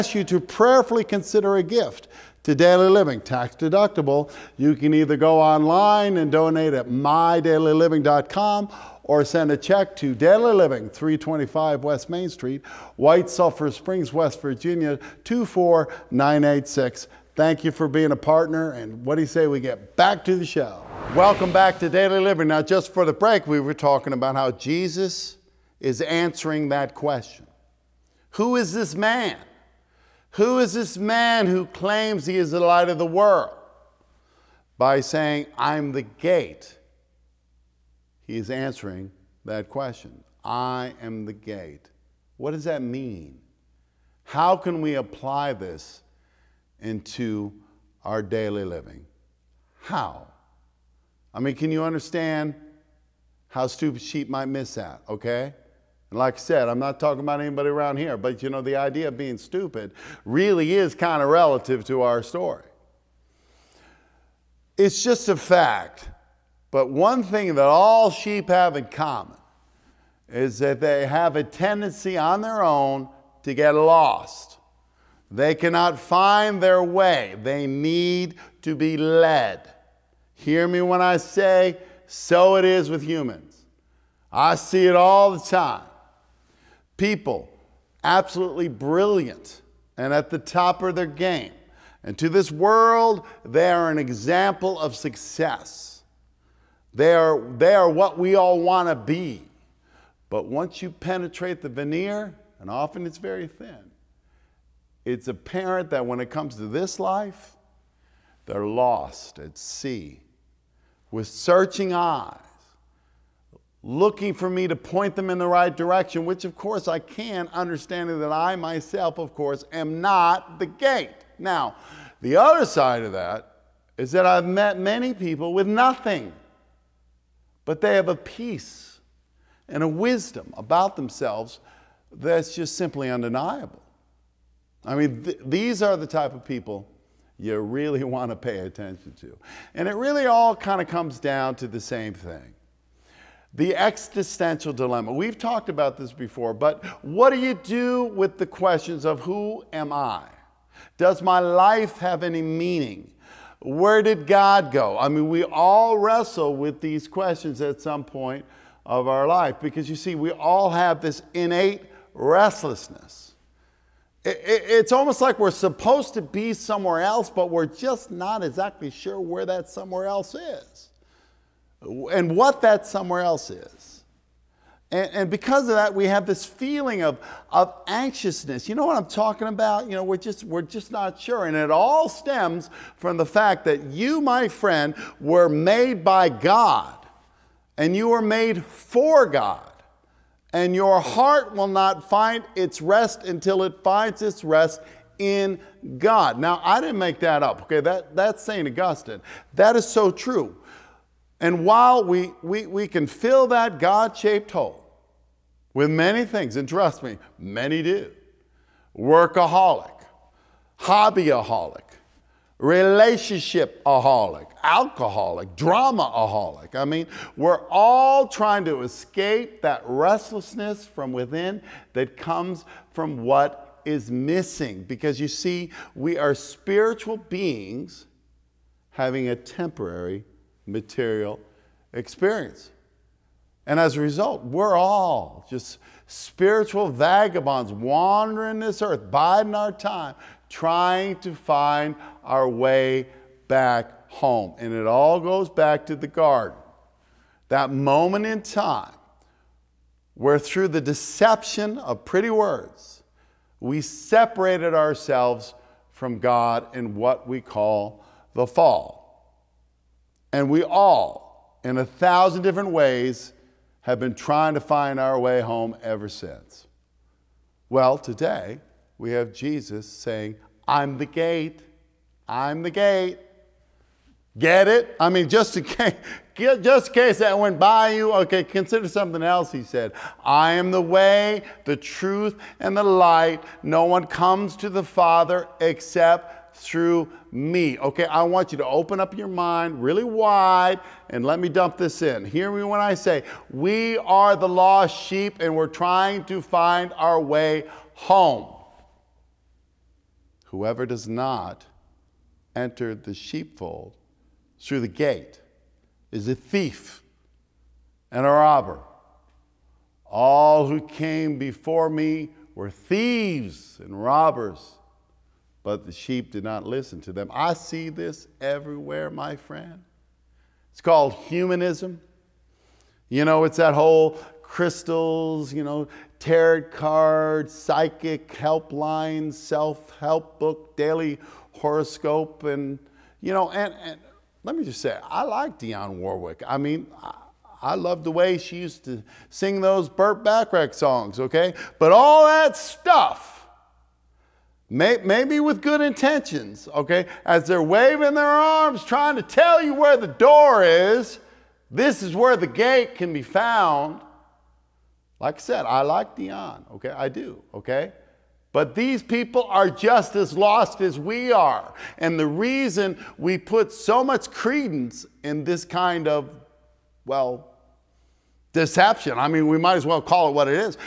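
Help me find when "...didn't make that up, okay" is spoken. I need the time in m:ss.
3:16.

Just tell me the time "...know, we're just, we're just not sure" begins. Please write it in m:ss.
2:59.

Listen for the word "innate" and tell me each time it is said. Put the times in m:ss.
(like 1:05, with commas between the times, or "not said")
2:41.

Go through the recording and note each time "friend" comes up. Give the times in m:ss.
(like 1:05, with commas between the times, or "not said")
3:04, 5:19.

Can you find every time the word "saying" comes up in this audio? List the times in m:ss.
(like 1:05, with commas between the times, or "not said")
0:35, 4:29.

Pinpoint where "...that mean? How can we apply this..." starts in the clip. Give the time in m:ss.
0:42.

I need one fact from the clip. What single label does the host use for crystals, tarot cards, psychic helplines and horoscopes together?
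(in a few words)
humanism.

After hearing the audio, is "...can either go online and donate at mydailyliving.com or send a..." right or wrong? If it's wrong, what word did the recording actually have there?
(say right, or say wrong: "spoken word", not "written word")
right.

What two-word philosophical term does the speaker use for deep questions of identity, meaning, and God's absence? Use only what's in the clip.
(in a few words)
existential dilemma.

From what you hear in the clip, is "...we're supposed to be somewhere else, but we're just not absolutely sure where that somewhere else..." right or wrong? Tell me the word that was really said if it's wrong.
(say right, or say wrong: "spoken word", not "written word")
wrong: "exactly", not "absolutely".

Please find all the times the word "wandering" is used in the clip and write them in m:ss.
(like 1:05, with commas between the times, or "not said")
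3:57.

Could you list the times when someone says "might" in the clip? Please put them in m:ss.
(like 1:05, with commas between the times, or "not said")
0:54, 6:09.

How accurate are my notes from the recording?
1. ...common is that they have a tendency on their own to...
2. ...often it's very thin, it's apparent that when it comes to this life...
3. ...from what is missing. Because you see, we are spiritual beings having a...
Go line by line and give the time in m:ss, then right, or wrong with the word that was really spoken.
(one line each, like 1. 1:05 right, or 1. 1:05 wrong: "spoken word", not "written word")
1. 1:08 right
2. 1:42 right
3. 3:42 right.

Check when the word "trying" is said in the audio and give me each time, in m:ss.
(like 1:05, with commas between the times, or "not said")
3:38, 4:00, 4:24, 4:55, 5:48.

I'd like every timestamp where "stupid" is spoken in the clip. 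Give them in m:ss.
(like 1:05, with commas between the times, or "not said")
0:53, 0:59.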